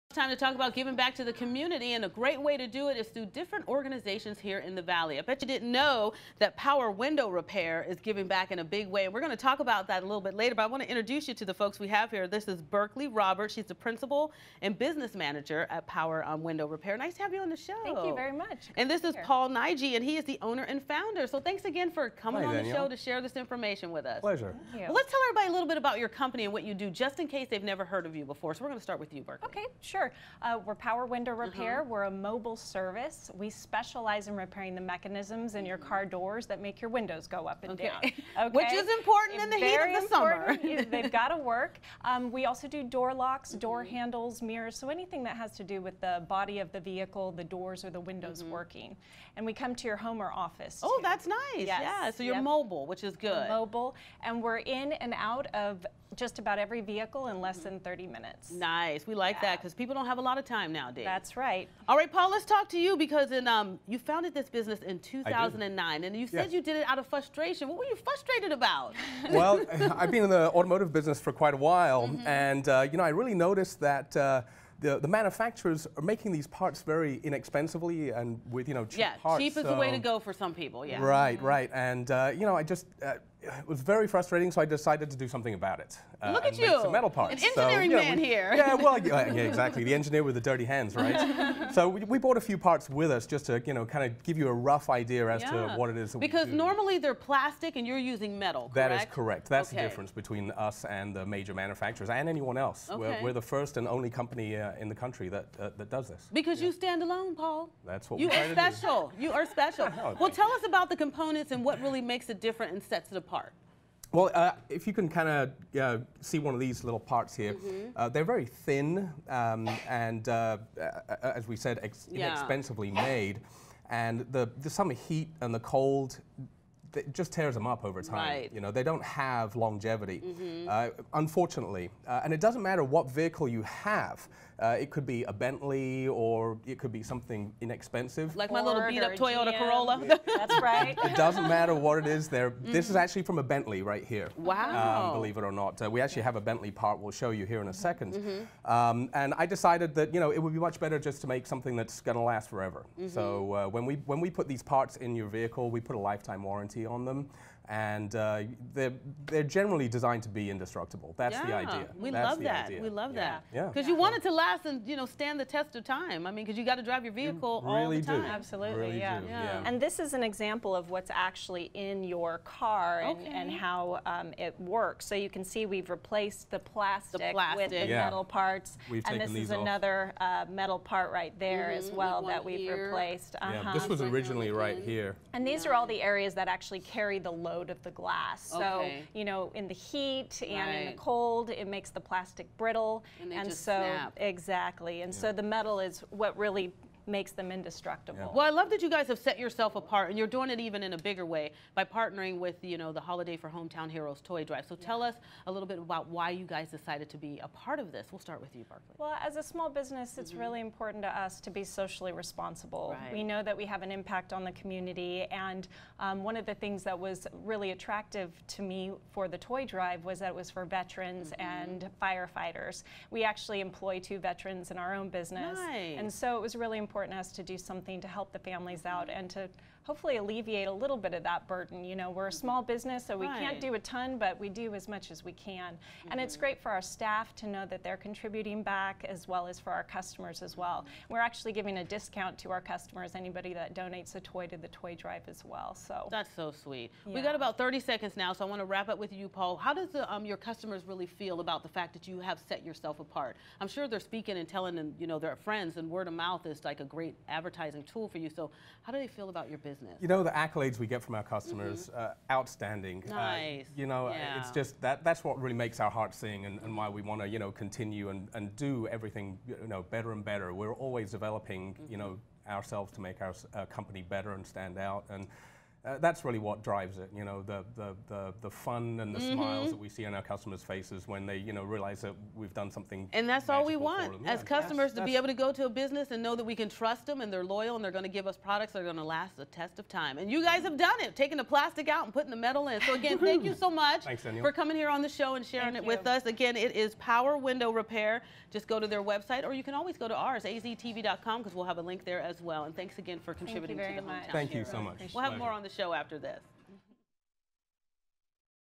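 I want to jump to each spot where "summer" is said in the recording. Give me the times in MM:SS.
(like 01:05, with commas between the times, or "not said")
00:40, 02:04.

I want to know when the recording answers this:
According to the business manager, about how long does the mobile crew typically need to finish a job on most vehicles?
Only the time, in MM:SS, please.
00:57.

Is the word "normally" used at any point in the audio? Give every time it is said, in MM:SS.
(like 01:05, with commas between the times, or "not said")
01:36.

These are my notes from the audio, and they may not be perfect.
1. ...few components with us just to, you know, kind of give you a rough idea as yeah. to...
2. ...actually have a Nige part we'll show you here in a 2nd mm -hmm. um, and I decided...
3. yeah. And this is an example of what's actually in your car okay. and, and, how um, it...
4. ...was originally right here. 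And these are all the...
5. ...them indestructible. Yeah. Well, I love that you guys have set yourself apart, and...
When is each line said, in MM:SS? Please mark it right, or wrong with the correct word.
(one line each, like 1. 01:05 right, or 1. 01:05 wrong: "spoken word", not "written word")
1. 01:32 wrong: "parts", not "components"
2. 02:26 wrong: "Bentley", not "Nige"
3. 02:49 right
4. 03:03 right
5. 03:17 right.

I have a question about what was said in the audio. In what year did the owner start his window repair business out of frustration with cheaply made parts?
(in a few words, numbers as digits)
2009.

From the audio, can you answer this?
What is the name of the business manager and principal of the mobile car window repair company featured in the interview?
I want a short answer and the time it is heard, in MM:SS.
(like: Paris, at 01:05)
Berkeley Roberts, at 00:12.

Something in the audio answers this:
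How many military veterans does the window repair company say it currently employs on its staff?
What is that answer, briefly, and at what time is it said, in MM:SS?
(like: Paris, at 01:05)
2, at 03:44.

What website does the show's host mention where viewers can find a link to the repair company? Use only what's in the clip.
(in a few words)
aztv.com.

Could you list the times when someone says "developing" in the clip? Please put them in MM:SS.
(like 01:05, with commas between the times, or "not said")
04:31.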